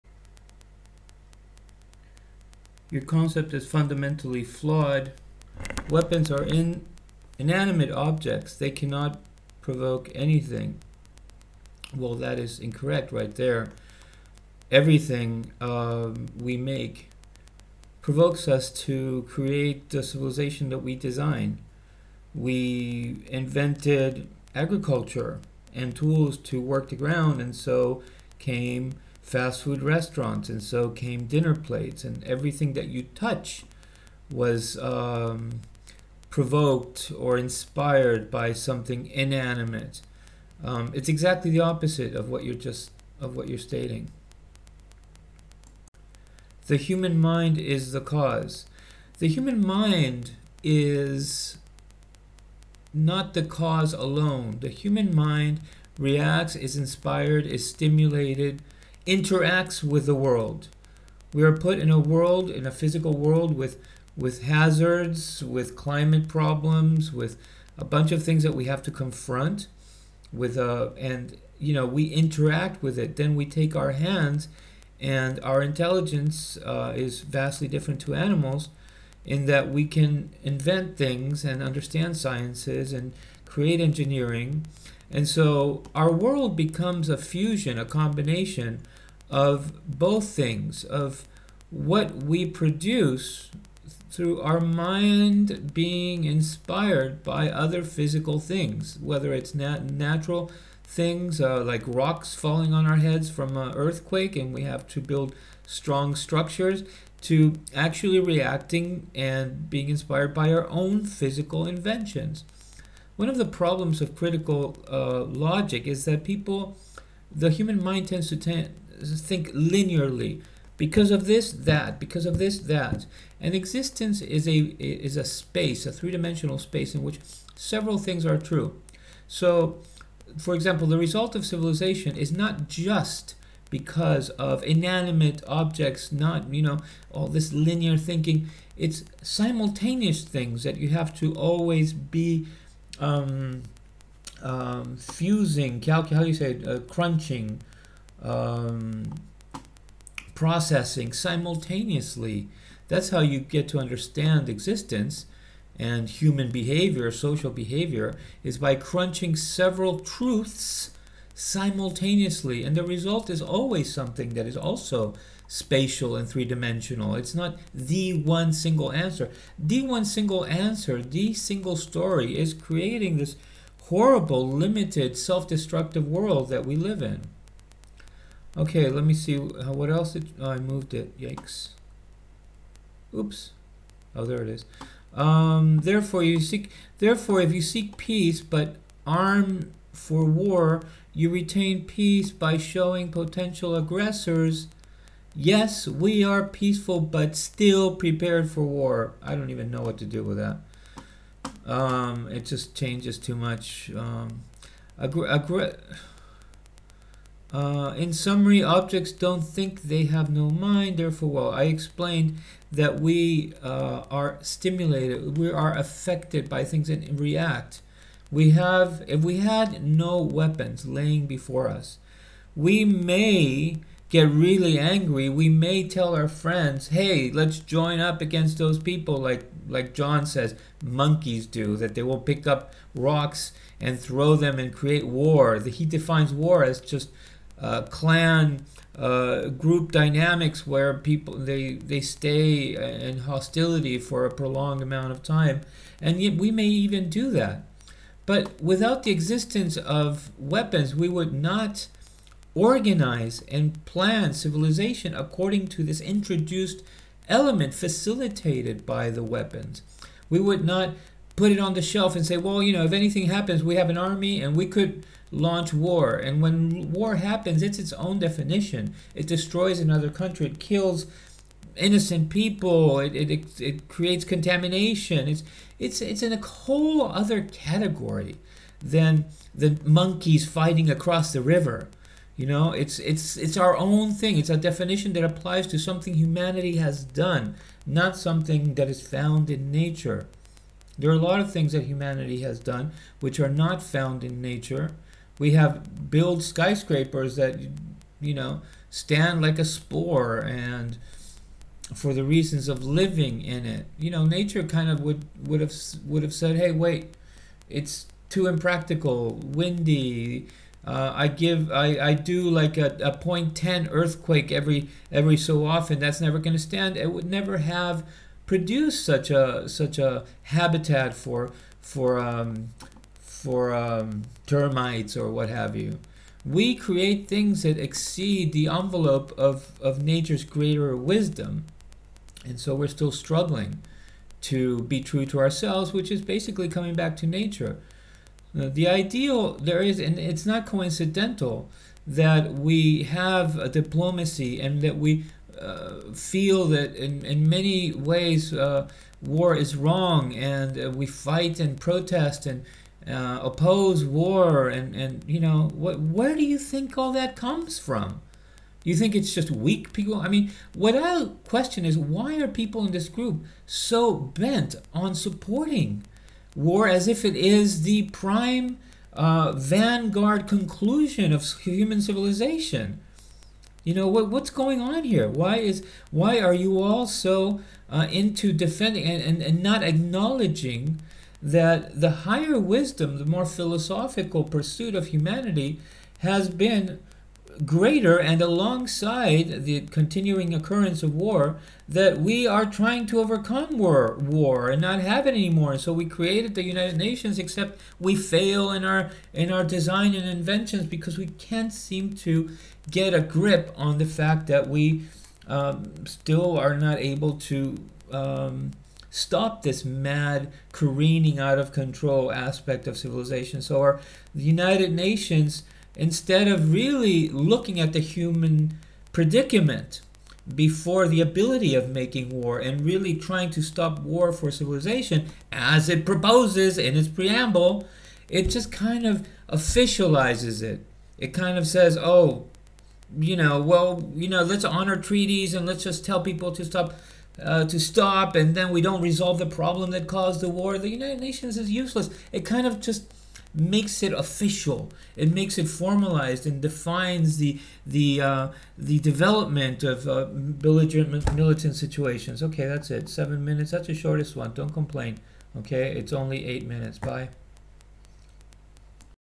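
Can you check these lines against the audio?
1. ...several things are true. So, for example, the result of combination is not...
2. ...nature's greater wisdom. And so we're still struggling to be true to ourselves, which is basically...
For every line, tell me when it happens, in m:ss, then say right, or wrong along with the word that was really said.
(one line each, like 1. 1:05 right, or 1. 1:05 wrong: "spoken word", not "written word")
1. 2:07 wrong: "civilization", not "combination"
2. 5:30 right.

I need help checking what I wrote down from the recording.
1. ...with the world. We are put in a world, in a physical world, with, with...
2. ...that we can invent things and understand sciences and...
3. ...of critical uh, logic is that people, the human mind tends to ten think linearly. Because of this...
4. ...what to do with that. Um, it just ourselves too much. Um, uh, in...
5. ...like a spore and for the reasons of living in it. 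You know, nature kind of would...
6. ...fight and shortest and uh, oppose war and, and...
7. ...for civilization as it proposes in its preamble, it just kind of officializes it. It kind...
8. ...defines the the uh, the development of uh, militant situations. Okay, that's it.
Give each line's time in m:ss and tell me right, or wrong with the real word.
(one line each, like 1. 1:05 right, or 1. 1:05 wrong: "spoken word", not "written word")
1. 0:59 right
2. 1:19 right
3. 1:54 right
4. 3:19 wrong: "changes", not "ourselves"
5. 4:59 right
6. 5:51 wrong: "protest", not "shortest"
7. 7:04 right
8. 7:26 right.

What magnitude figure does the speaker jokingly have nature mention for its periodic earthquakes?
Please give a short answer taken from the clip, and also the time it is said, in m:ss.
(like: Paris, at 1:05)
0.10, at 5:13.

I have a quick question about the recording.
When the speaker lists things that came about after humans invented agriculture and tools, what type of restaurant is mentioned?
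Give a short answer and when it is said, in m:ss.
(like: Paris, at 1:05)
fast food restaurants, at 0:29.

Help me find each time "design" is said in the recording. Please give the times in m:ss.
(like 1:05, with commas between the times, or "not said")
0:20, 6:39.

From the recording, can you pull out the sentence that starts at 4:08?
But without the existence of weapons, we would not organize and plan civilization according to this introduced element facilitated by the weapons.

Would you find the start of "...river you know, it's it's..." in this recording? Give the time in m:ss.
4:41.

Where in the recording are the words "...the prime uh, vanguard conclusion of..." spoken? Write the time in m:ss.
6:07.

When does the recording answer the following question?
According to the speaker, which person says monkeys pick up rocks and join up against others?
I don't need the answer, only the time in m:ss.
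3:49.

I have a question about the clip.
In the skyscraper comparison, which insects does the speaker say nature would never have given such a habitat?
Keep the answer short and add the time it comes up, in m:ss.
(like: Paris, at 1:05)
termites, at 5:24.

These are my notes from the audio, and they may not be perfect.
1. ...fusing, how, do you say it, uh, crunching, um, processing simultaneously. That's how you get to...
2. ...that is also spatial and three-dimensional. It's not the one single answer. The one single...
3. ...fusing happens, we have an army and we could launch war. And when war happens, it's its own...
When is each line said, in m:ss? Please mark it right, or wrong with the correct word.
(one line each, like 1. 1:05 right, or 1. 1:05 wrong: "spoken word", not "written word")
1. 2:24 right
2. 2:44 right
3. 4:22 wrong: "anything", not "fusing".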